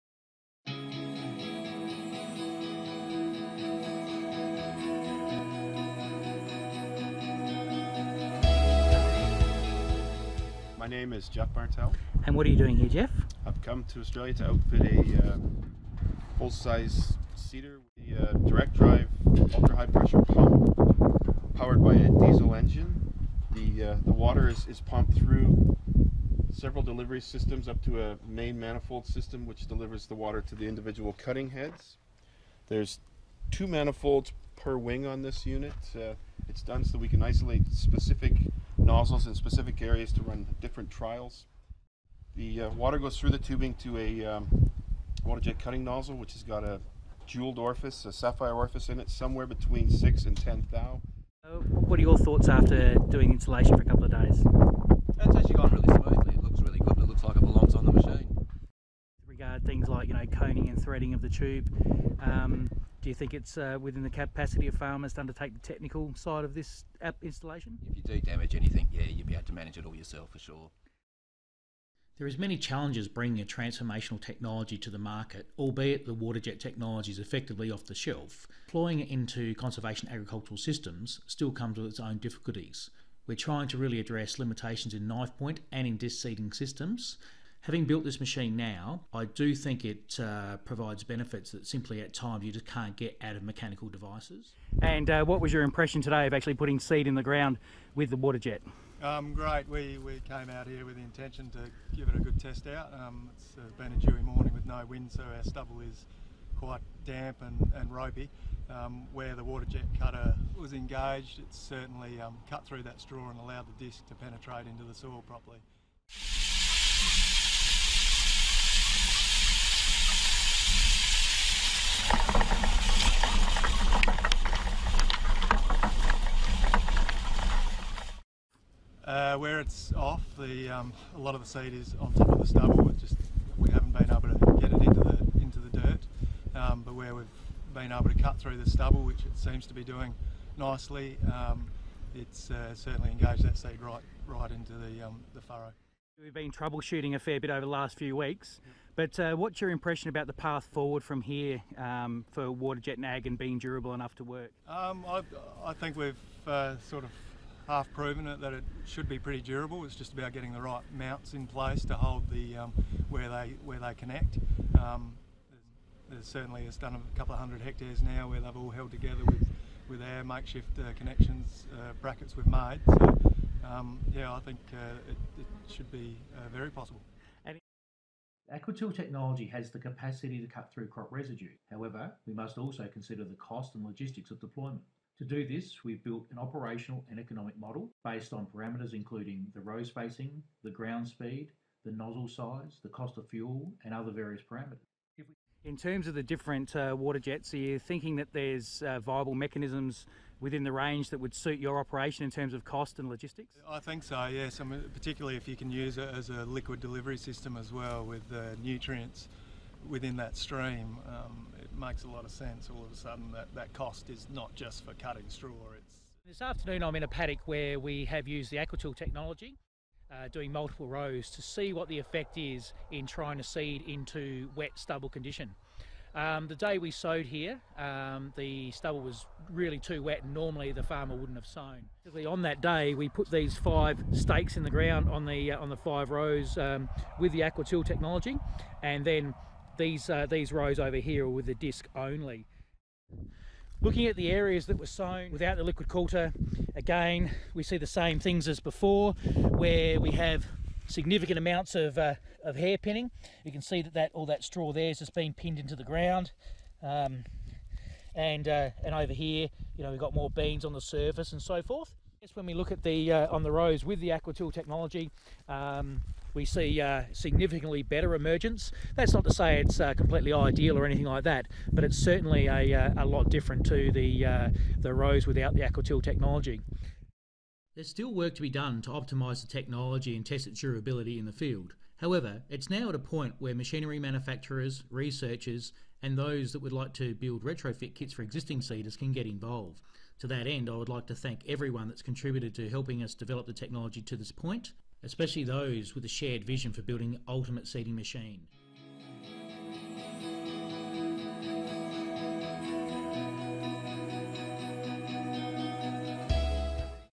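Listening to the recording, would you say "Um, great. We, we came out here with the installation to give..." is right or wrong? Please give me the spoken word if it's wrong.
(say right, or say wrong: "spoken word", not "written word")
wrong: "intention", not "installation".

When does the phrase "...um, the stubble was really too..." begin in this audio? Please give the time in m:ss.
3:47.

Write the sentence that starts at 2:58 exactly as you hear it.
AquaTill technology has the capacity to cut through crop residue.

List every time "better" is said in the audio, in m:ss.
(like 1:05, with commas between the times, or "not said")
4:27.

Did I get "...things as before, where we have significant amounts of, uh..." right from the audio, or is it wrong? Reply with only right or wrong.
right.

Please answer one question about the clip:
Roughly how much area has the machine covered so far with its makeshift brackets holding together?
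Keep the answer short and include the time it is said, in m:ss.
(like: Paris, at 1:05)
A couple of hundred hectares, at 2:46.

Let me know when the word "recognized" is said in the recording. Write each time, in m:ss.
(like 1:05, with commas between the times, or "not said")
not said.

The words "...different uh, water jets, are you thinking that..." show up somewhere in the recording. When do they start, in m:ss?
3:16.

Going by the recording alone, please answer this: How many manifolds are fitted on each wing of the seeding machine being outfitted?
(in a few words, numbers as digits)
2.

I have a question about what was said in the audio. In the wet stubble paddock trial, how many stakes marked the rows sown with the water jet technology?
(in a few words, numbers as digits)
5.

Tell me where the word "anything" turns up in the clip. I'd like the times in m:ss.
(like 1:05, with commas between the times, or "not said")
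1:08, 4:30.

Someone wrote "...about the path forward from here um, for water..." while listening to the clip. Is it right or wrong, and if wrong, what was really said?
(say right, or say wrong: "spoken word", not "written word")
right.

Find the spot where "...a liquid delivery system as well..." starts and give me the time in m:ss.
3:26.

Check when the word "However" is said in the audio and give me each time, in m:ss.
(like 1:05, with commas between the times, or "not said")
3:01, 4:41.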